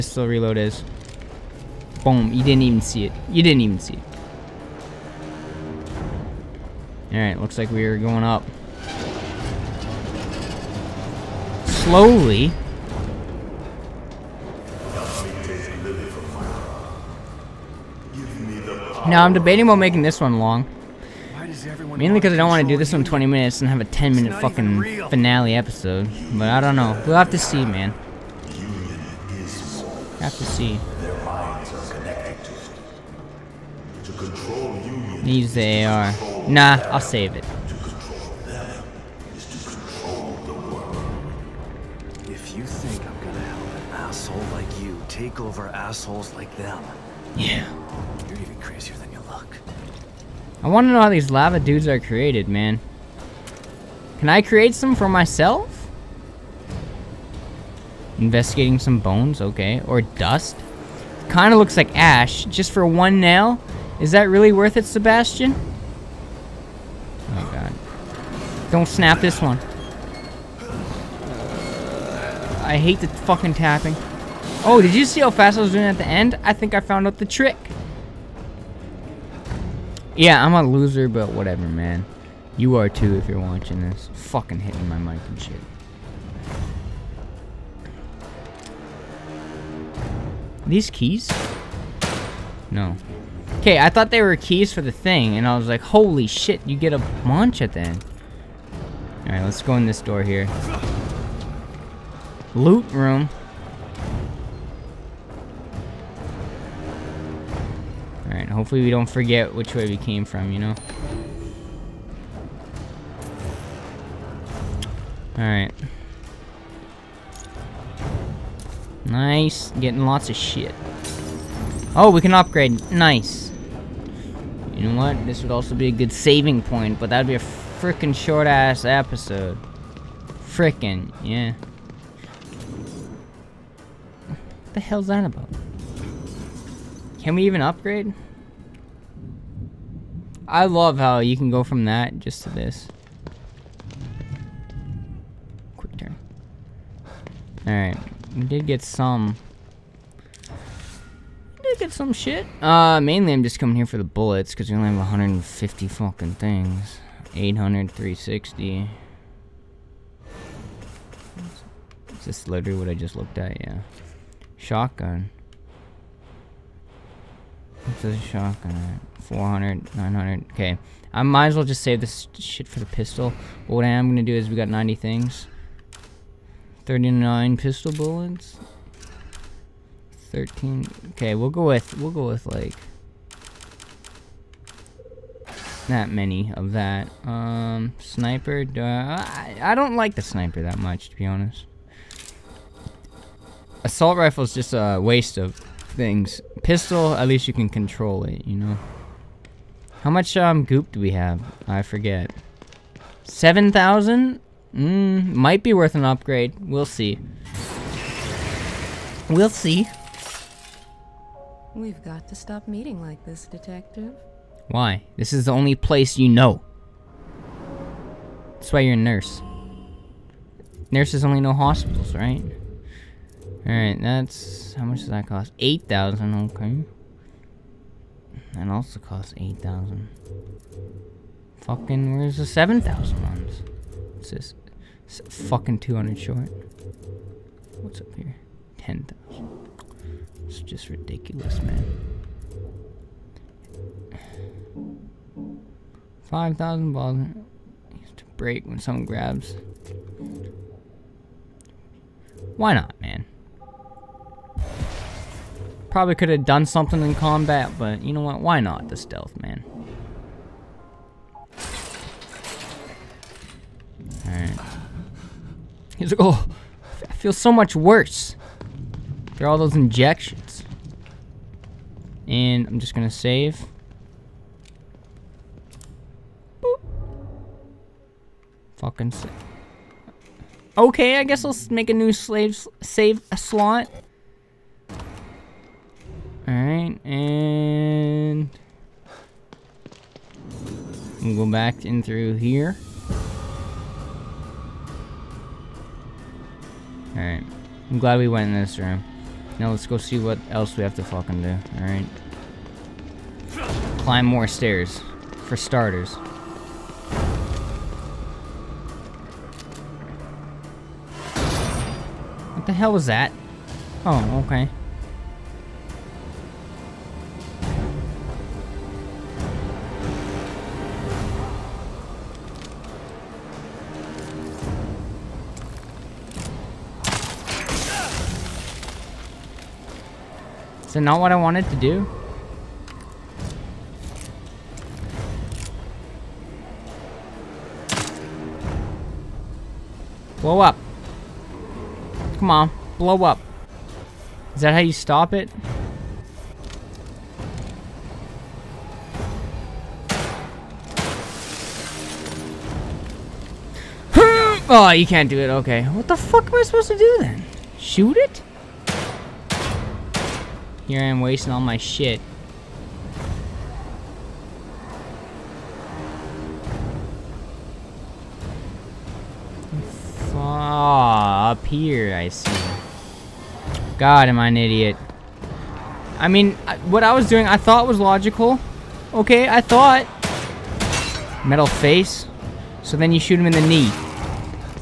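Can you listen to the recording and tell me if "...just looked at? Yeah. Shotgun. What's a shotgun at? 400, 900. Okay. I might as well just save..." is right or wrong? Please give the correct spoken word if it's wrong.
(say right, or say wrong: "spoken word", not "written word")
right.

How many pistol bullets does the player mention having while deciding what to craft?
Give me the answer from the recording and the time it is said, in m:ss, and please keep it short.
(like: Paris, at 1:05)
39, at 2:56.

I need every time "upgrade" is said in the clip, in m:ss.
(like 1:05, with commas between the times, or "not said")
2:02, 2:17, 3:26.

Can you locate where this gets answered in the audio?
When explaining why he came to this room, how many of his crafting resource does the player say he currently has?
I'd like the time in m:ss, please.
2:34.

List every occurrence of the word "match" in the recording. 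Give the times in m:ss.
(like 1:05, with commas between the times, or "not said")
not said.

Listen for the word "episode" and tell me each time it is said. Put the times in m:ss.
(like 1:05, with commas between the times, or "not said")
0:25, 2:08.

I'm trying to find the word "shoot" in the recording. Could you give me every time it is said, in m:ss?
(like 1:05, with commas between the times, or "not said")
5:57, 6:23.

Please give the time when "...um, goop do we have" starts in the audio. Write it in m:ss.
3:20.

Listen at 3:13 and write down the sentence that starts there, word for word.
Assault rifle is just a waste of things.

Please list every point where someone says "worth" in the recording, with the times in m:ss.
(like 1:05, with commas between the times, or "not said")
1:04, 3:25.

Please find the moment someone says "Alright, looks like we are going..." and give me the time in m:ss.
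0:07.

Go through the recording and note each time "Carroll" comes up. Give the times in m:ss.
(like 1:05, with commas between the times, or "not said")
not said.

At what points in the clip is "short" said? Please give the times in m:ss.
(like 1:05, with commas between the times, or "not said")
2:08, 3:56.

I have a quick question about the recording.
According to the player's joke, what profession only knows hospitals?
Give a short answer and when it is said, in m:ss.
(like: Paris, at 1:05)
Nurses, at 3:40.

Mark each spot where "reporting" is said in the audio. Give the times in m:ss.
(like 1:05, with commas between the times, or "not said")
not said.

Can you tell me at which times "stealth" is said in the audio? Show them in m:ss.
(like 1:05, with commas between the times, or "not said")
4:18.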